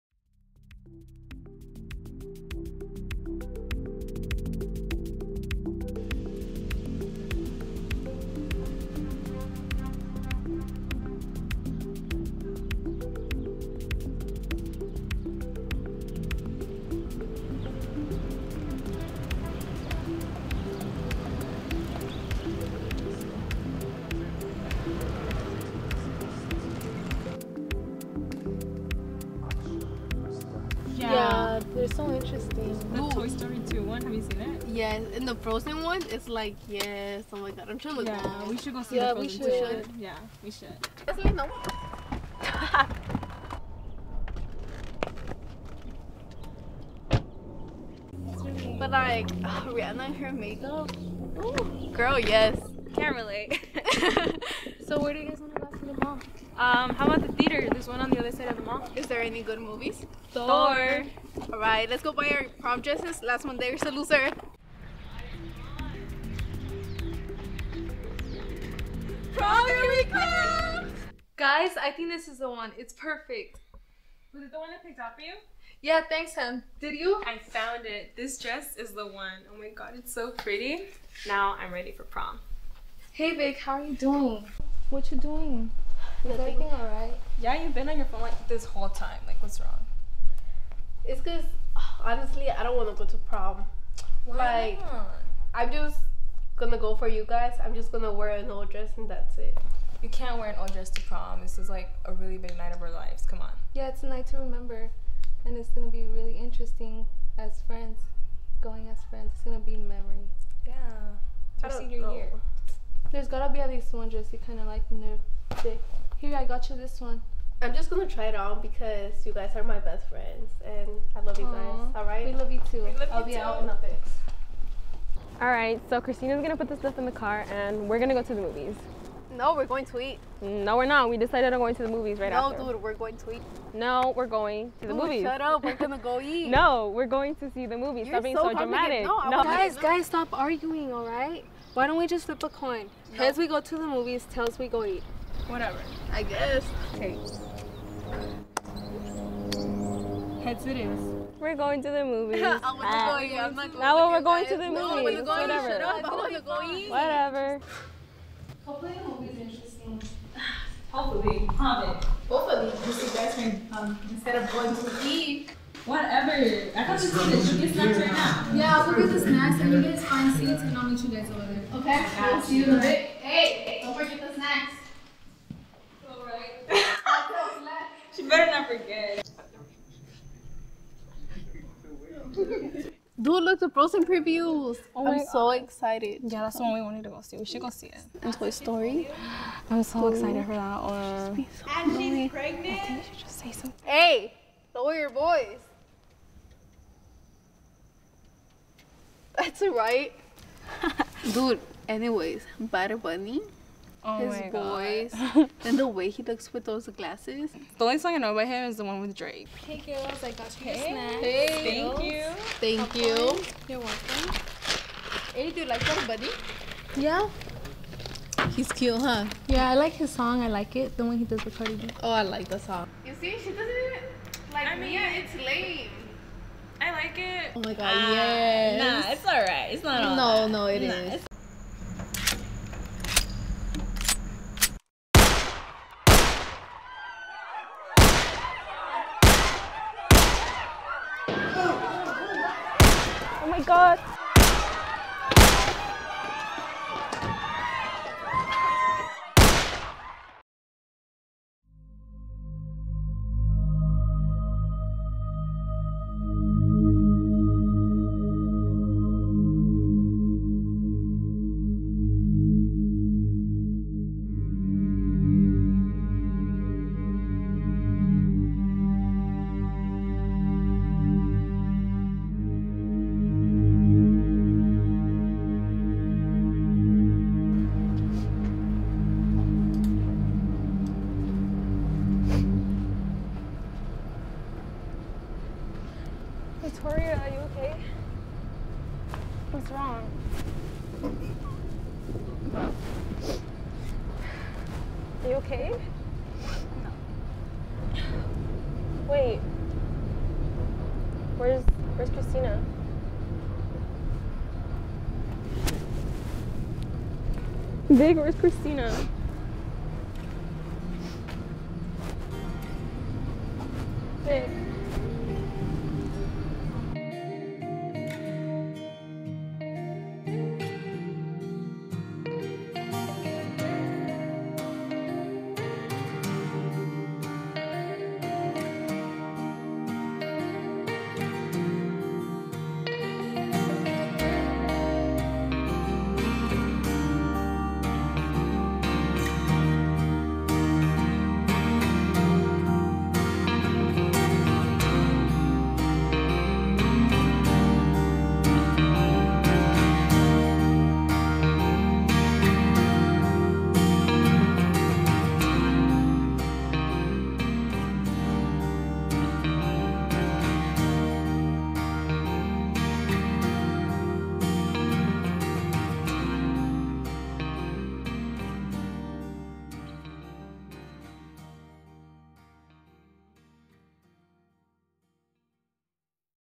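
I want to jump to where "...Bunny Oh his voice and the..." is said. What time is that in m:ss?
3:23.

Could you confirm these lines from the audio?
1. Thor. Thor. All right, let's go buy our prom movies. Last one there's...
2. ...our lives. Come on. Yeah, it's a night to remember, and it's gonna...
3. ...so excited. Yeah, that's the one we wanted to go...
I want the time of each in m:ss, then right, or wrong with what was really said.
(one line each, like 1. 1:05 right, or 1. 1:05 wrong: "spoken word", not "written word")
1. 1:00 wrong: "dresses", not "movies"
2. 1:42 right
3. 3:05 right.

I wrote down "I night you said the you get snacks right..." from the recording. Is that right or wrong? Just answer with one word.
wrong.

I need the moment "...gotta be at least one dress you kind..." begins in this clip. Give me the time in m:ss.
1:53.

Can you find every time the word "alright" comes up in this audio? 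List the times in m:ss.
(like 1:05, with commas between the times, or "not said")
1:26, 3:49.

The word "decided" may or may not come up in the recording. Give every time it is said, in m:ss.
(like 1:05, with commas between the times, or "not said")
2:11.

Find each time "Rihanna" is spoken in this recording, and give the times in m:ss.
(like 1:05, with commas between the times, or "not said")
0:49.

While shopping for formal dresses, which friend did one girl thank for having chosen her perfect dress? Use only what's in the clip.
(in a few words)
Sam.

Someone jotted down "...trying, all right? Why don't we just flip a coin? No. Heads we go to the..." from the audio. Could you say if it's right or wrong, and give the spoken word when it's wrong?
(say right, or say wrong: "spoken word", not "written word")
wrong: "arguing", not "trying".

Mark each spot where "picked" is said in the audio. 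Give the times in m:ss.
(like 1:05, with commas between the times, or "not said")
1:14.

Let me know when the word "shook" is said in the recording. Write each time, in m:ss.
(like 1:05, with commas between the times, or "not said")
not said.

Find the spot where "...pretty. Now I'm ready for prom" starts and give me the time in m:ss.
1:20.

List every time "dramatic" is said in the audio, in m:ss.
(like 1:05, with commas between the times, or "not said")
2:18.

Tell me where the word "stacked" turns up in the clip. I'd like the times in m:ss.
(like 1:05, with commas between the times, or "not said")
not said.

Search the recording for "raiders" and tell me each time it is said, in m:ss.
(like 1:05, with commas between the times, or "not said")
not said.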